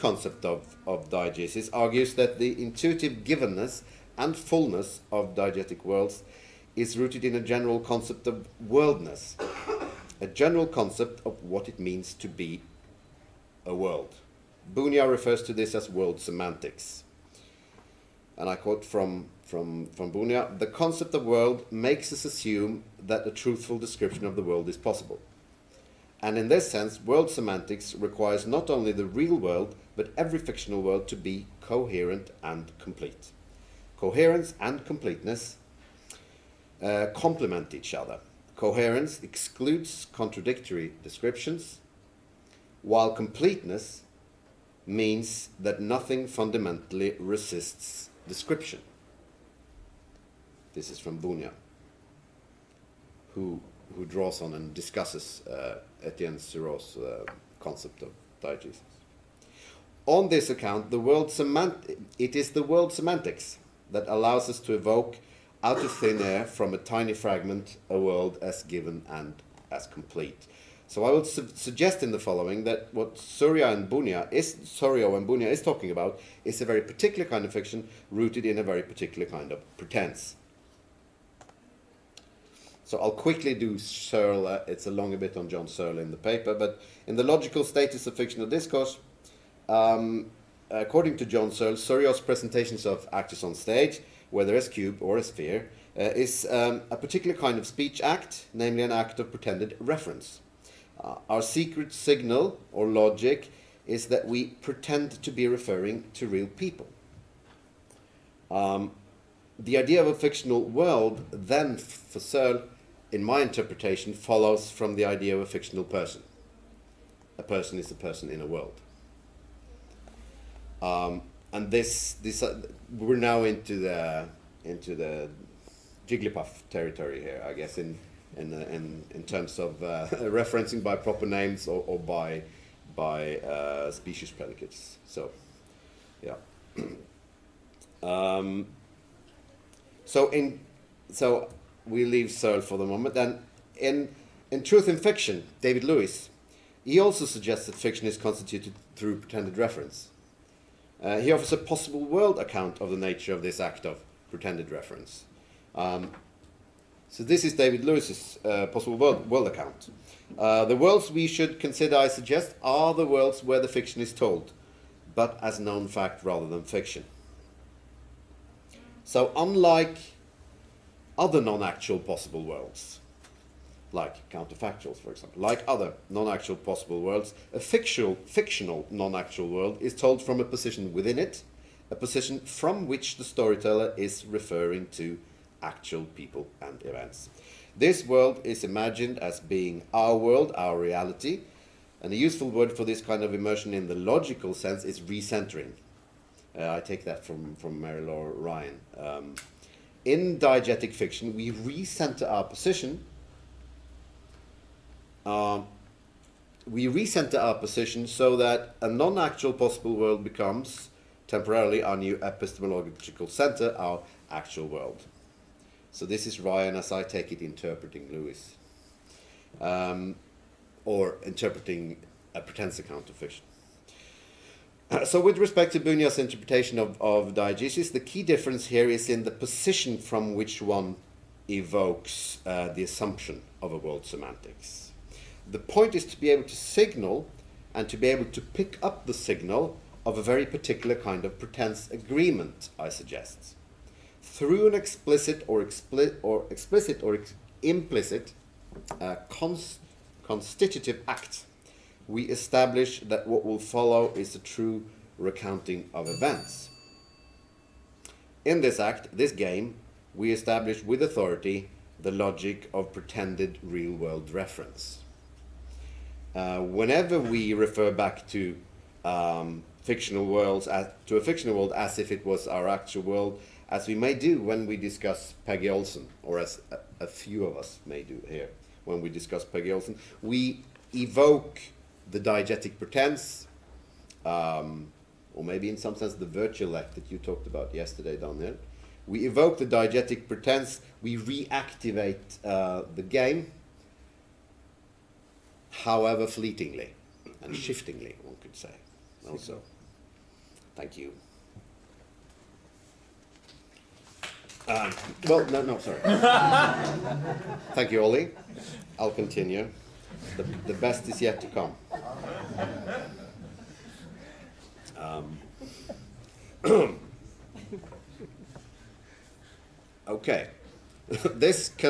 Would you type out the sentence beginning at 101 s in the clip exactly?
Uh, our secret signal or logic is that we pretend to be referring to real people.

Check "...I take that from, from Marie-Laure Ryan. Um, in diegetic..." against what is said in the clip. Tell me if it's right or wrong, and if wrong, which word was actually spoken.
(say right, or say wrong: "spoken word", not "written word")
right.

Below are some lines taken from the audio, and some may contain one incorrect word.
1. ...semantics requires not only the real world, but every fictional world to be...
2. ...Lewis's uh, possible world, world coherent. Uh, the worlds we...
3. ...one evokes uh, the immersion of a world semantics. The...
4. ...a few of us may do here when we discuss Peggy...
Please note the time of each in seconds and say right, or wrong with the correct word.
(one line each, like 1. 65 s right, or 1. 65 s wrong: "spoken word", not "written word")
1. 27 s right
2. 157 s wrong: "account", not "coherent"
3. 230 s wrong: "assumption", not "immersion"
4. 277 s right.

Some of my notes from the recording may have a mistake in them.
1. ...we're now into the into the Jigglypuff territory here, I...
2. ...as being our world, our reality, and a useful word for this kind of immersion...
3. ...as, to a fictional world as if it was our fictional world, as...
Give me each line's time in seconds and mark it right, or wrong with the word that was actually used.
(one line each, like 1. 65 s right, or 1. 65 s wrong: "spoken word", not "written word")
1. 122 s right
2. 189 s right
3. 270 s wrong: "actual", not "fictional".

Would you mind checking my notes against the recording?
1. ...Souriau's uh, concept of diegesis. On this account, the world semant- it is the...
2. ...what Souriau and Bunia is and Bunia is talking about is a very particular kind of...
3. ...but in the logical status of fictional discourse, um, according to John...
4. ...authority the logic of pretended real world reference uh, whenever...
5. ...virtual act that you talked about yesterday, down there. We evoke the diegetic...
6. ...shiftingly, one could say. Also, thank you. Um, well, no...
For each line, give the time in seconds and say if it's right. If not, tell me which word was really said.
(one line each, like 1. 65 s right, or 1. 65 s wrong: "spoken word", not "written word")
1. 56 s right
2. 72 s right
3. 86 s right
4. 261 s right
5. 286 s right
6. 297 s right.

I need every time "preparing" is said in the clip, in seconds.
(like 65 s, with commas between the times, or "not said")
not said.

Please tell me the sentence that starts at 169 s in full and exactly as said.
So unlike other non-actual possible worlds, like counterfactuals, for example.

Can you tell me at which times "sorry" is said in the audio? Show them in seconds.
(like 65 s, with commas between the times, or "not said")
305 s.